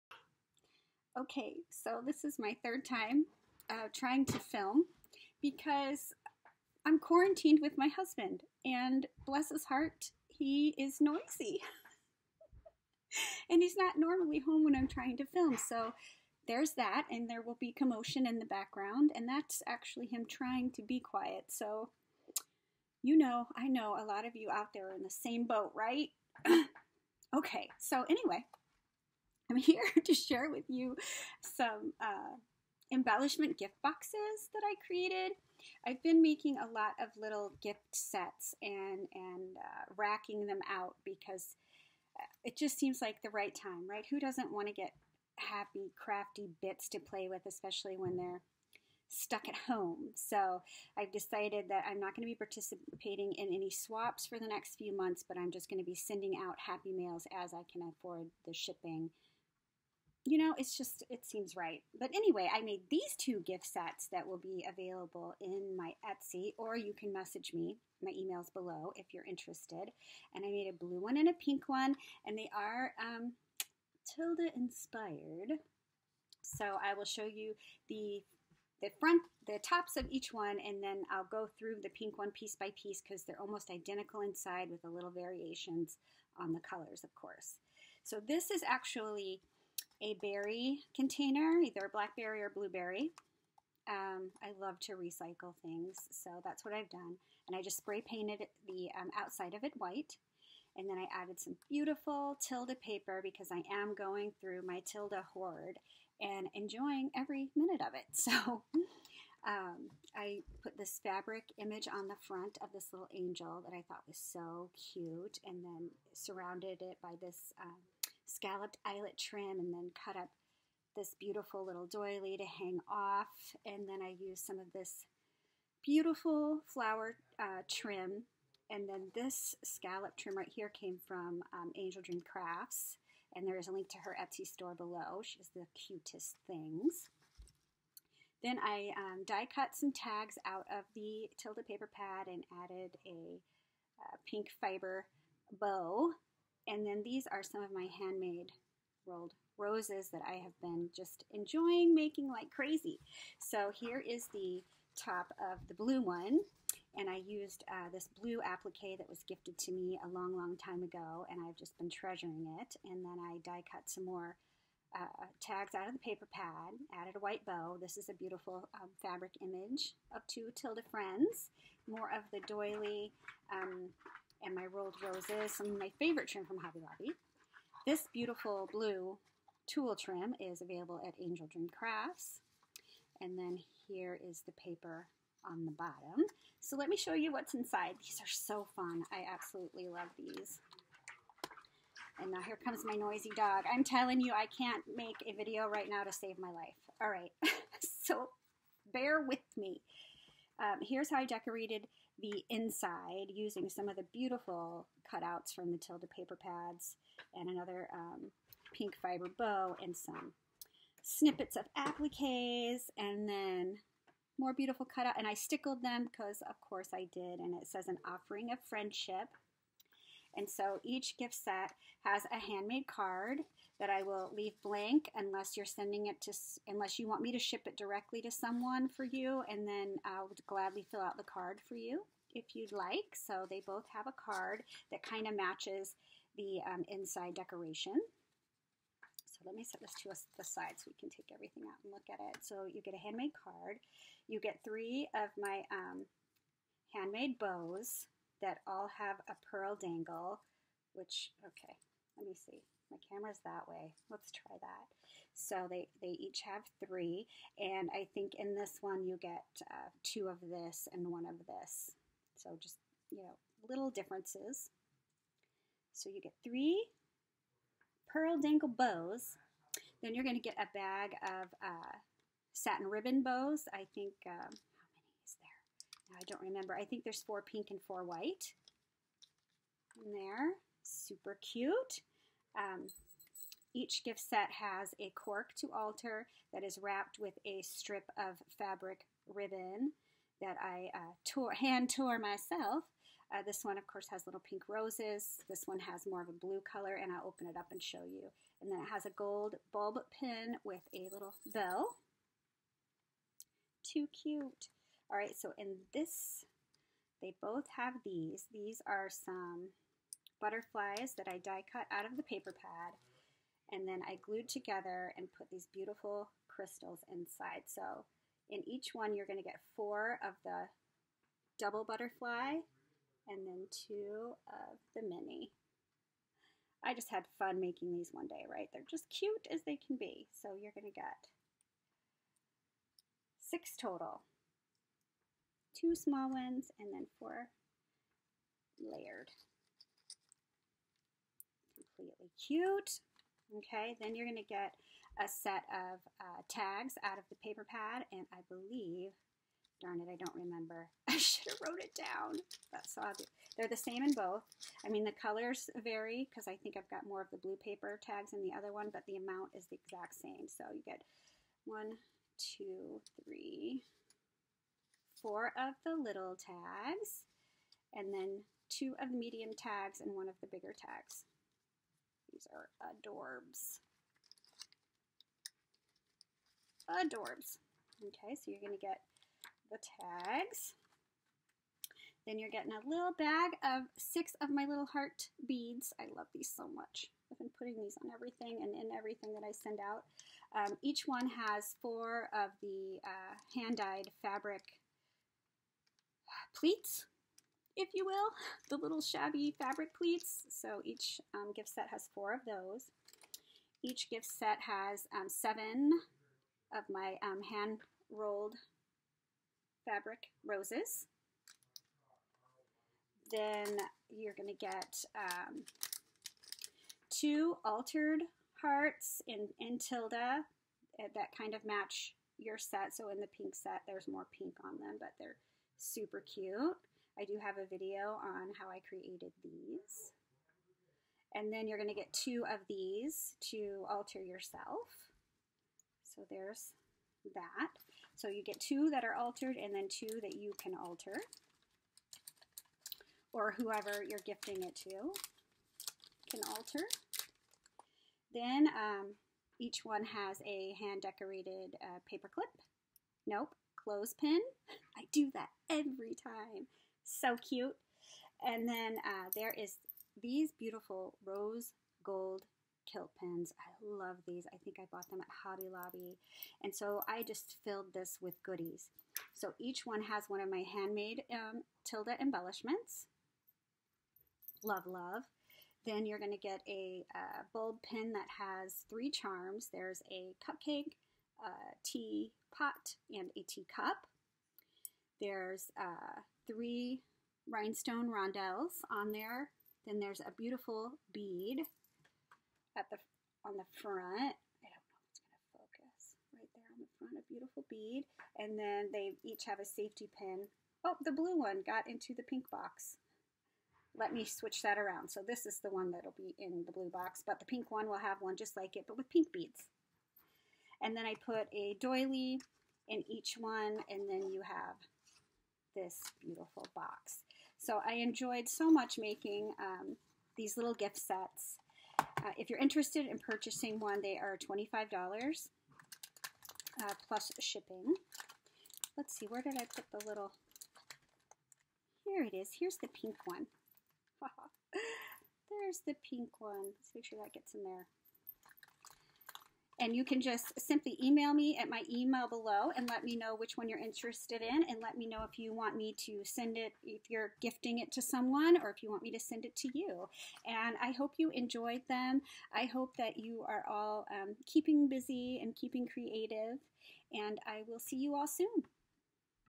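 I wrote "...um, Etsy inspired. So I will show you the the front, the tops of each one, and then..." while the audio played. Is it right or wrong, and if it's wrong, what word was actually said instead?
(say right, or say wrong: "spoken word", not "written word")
wrong: "Tilda", not "Etsy".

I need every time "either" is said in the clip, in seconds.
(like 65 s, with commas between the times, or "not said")
91 s.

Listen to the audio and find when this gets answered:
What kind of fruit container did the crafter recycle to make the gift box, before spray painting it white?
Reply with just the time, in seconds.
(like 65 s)
90 s.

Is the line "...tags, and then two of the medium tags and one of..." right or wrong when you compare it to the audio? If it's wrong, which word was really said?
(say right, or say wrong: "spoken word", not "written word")
right.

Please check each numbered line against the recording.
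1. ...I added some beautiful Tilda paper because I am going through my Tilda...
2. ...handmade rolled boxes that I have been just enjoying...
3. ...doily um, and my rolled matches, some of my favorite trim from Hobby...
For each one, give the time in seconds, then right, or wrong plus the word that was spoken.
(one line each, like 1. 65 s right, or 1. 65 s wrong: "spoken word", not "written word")
1. 100 s right
2. 147 s wrong: "roses", not "boxes"
3. 172 s wrong: "roses", not "matches".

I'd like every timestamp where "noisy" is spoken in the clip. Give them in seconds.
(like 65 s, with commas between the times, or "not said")
11 s, 192 s.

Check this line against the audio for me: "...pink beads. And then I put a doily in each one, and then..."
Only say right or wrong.
right.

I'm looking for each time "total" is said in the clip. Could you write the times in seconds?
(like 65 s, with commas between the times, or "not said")
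333 s.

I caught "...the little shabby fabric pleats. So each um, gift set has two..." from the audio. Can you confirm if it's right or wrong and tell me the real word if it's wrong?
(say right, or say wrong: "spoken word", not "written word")
wrong: "four", not "two".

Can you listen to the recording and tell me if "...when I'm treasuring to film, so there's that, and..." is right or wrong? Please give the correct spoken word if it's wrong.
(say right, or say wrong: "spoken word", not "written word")
wrong: "trying", not "treasuring".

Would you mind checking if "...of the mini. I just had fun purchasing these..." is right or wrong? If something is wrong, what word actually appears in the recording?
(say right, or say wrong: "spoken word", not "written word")
wrong: "making", not "purchasing".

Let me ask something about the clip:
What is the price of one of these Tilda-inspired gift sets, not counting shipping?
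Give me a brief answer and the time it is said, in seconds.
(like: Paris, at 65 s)
$25, at 524 s.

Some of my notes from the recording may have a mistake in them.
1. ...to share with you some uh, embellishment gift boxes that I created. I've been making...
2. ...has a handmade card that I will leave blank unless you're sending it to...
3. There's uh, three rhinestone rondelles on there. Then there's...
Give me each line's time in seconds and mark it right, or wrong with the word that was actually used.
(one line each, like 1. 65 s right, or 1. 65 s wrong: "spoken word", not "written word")
1. 30 s right
2. 222 s right
3. 485 s right.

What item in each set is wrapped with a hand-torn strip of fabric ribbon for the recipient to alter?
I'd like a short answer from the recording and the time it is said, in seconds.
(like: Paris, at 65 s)
cork, at 285 s.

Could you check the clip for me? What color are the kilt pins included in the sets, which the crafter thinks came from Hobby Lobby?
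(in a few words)
rose gold.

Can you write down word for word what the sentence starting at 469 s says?
So each one has one of my handmade um, Tilda embellishments.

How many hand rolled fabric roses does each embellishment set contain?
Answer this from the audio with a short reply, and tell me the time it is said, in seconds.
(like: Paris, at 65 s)
7, at 405 s.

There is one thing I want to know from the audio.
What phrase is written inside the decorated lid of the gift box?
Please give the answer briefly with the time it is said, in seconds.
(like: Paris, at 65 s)
an offering of friendship, at 217 s.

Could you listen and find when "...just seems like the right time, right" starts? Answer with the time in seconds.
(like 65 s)
42 s.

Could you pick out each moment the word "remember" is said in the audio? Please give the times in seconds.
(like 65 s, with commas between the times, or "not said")
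276 s, 350 s.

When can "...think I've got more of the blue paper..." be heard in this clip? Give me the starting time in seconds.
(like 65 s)
356 s.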